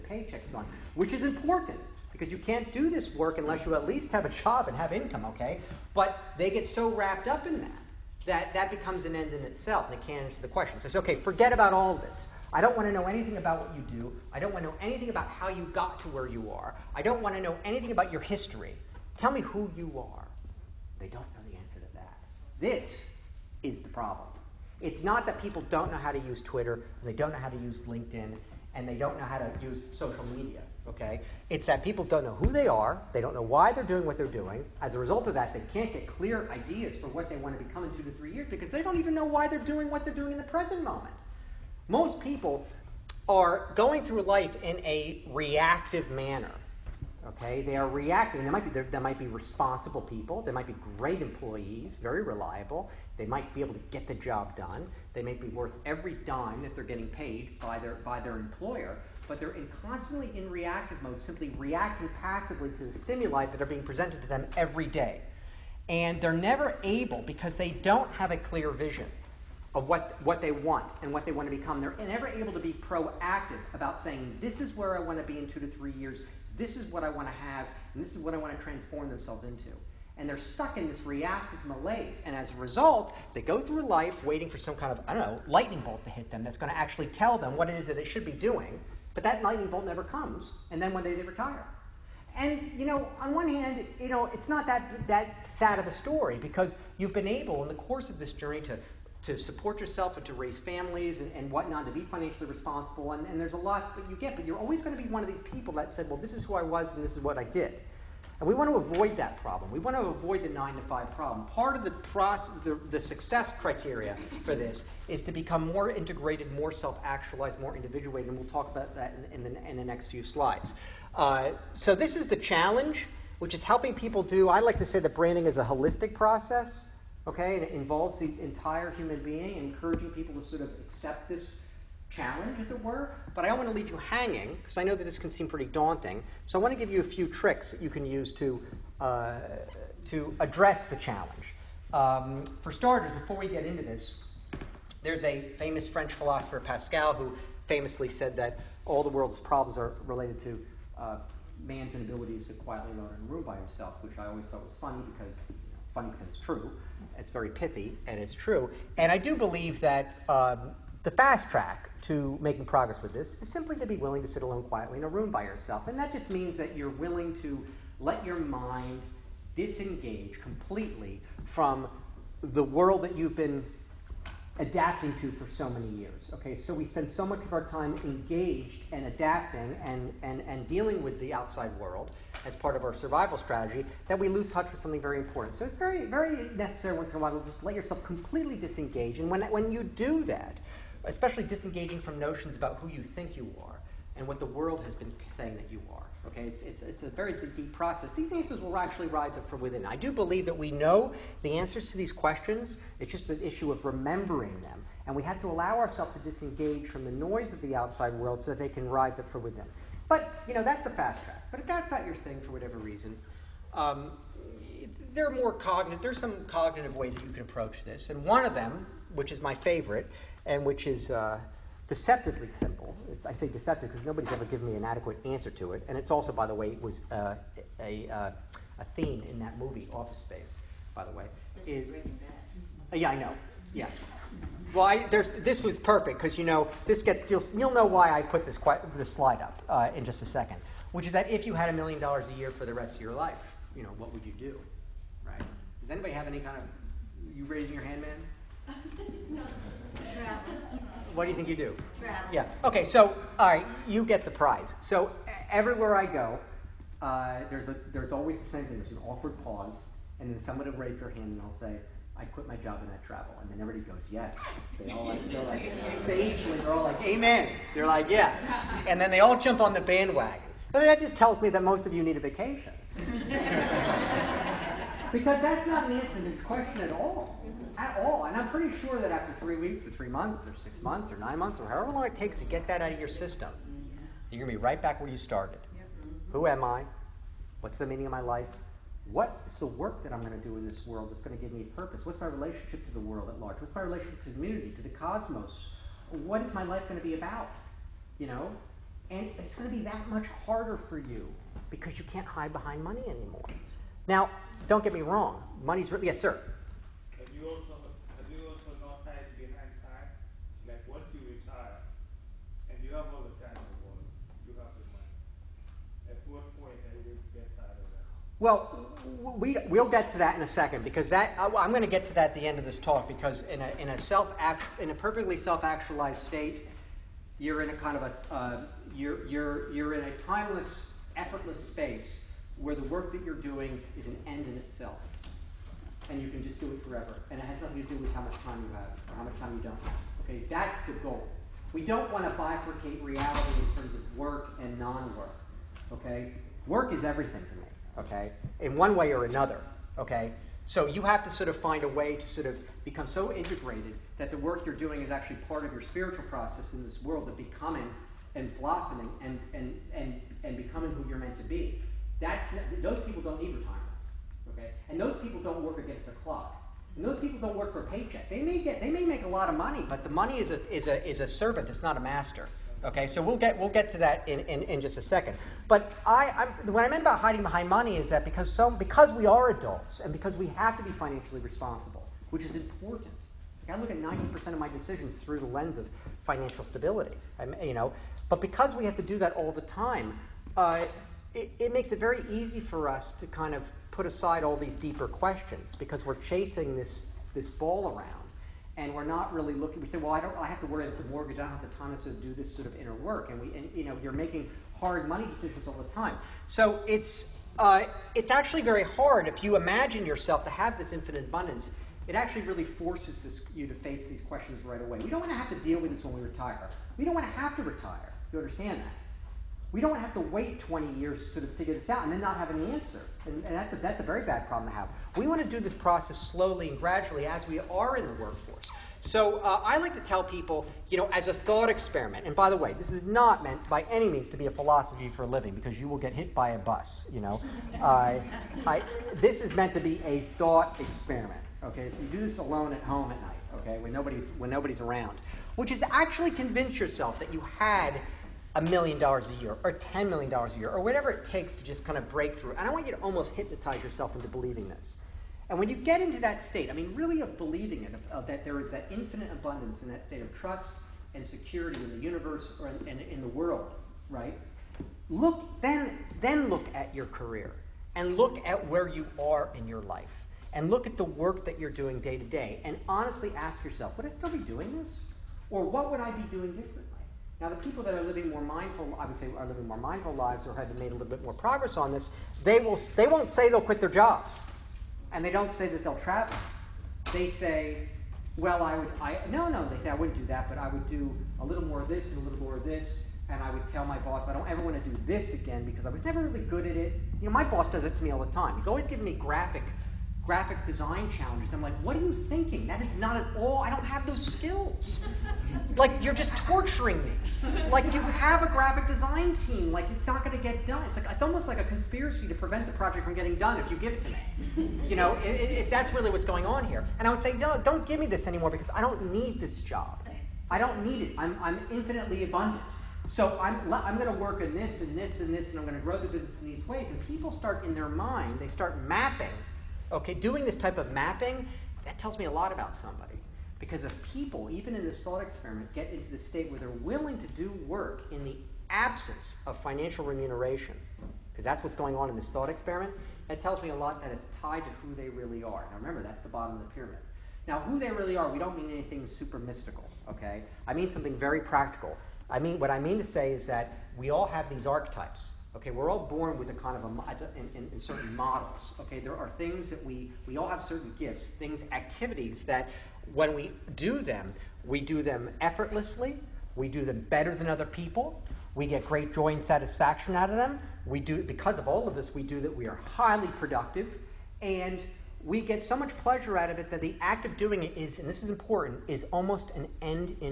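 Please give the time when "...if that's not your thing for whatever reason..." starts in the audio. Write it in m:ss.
3:31.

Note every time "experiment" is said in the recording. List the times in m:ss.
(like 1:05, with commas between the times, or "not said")
7:11, 7:20, 8:55, 9:02.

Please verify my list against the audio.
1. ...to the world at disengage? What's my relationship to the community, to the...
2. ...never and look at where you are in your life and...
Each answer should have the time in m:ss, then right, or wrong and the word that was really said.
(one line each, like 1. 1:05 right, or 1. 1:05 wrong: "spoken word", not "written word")
1. 4:52 wrong: "large", not "disengage"
2. 7:47 wrong: "career", not "never".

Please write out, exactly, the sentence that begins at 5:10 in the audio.
Like once you retire and you have all the time in the world, you have the money.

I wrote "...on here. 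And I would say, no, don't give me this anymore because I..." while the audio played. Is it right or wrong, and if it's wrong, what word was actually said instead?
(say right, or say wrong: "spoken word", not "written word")
right.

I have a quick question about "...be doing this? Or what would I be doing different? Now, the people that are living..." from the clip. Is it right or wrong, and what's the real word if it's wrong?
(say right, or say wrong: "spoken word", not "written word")
right.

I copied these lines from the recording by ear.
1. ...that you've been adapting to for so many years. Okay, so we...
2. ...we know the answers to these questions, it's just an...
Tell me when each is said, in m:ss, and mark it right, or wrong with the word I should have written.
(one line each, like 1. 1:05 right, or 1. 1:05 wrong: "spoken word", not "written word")
1. 2:53 right
2. 3:20 right.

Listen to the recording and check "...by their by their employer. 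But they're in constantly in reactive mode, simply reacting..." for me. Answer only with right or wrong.
right.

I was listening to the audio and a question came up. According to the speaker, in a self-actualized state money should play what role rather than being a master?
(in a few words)
a servant.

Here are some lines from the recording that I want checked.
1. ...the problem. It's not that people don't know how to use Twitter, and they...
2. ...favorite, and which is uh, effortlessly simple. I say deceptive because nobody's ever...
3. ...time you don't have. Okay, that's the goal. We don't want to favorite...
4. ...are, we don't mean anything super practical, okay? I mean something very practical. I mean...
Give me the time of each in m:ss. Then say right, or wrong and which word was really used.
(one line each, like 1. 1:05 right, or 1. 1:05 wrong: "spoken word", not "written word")
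1. 0:23 right
2. 3:39 wrong: "deceptively", not "effortlessly"
3. 5:39 wrong: "bifurcate", not "favorite"
4. 9:08 wrong: "mystical", not "practical".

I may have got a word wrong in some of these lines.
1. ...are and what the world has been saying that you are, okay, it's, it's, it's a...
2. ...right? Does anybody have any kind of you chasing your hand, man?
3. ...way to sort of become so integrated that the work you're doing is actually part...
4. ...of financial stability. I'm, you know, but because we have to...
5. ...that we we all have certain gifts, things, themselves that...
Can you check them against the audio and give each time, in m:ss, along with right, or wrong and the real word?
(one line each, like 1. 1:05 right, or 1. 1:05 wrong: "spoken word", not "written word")
1. 3:13 right
2. 4:05 wrong: "raising", not "chasing"
3. 5:51 right
4. 6:25 right
5. 9:19 wrong: "activities", not "themselves".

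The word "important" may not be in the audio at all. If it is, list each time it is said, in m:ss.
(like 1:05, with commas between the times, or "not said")
0:01, 3:05, 6:22, 9:38.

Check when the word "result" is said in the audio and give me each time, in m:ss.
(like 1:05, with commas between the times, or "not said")
0:34, 1:22.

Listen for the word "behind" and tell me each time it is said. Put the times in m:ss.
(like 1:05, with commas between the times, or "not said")
5:02, 5:09, 6:17.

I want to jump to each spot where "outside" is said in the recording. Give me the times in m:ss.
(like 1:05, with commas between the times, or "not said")
3:01, 3:27.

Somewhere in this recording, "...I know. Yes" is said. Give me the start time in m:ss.
3:53.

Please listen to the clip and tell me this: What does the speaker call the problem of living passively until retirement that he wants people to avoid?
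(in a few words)
the nine to five problem.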